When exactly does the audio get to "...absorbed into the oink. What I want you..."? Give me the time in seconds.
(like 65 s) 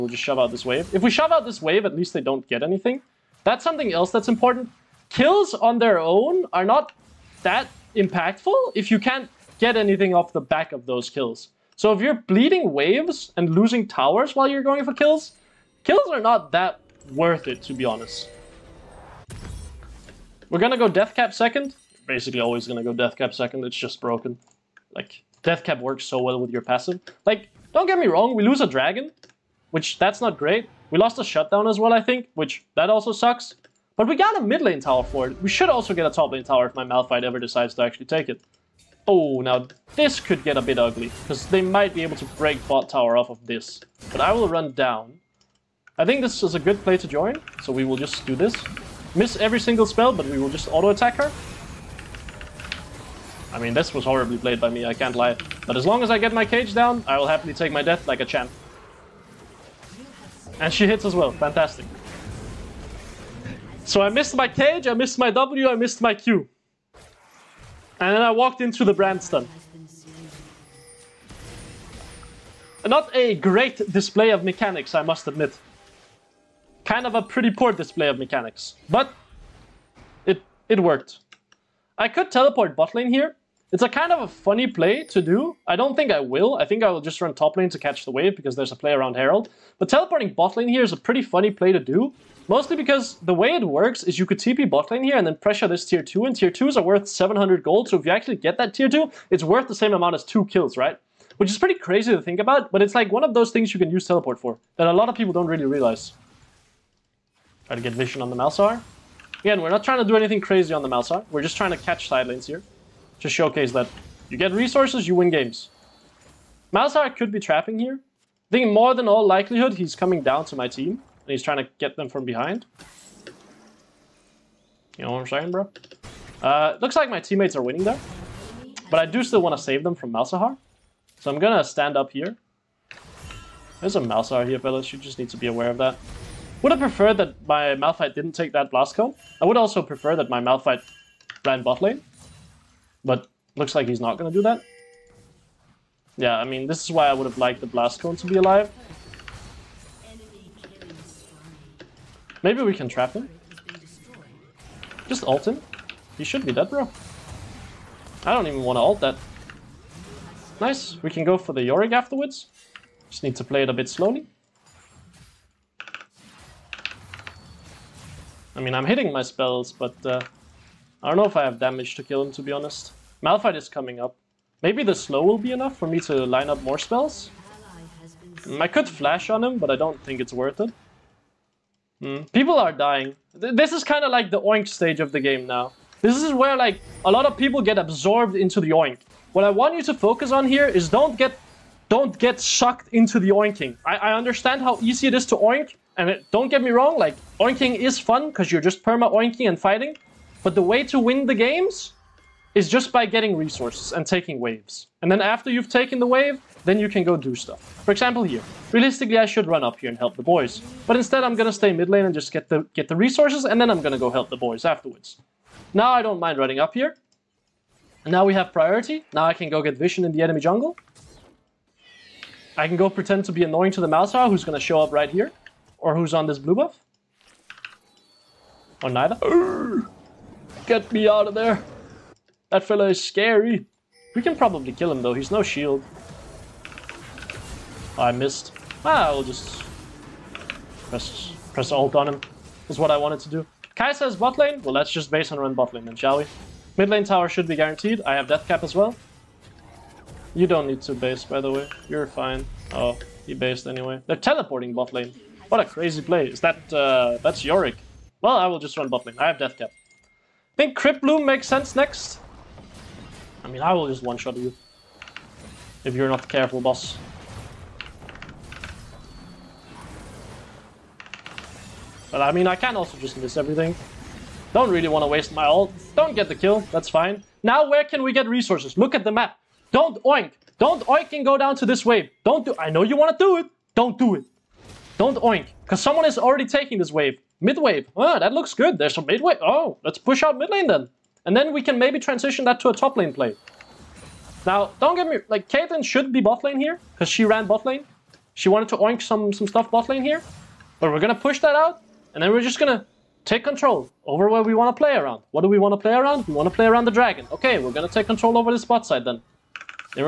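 187 s.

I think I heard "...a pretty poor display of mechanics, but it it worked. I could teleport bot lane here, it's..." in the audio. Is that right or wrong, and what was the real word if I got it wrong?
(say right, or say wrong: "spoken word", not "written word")
right.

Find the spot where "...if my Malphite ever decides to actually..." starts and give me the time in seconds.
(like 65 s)
36 s.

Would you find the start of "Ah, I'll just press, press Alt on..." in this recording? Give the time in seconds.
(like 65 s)
238 s.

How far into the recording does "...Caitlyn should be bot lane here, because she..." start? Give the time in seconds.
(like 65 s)
295 s.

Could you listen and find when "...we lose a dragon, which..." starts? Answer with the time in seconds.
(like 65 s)
28 s.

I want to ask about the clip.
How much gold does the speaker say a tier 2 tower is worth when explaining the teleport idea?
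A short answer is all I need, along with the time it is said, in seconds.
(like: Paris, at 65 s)
700, at 97 s.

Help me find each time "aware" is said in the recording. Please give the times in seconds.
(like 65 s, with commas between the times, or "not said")
135 s.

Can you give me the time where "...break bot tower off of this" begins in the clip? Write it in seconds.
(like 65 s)
42 s.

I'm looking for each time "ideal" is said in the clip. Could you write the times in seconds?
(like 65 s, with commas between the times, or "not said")
not said.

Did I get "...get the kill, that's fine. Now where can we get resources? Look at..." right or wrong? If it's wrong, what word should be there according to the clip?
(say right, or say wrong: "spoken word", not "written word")
right.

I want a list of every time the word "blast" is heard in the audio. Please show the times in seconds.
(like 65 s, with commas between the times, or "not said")
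138 s, 147 s.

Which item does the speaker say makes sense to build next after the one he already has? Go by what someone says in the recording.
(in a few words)
Crypt Bloom.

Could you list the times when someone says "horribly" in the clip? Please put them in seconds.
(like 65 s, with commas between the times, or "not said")
54 s.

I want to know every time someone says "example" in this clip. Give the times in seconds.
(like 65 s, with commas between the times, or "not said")
207 s.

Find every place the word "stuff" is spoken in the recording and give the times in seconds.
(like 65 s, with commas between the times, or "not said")
207 s, 299 s.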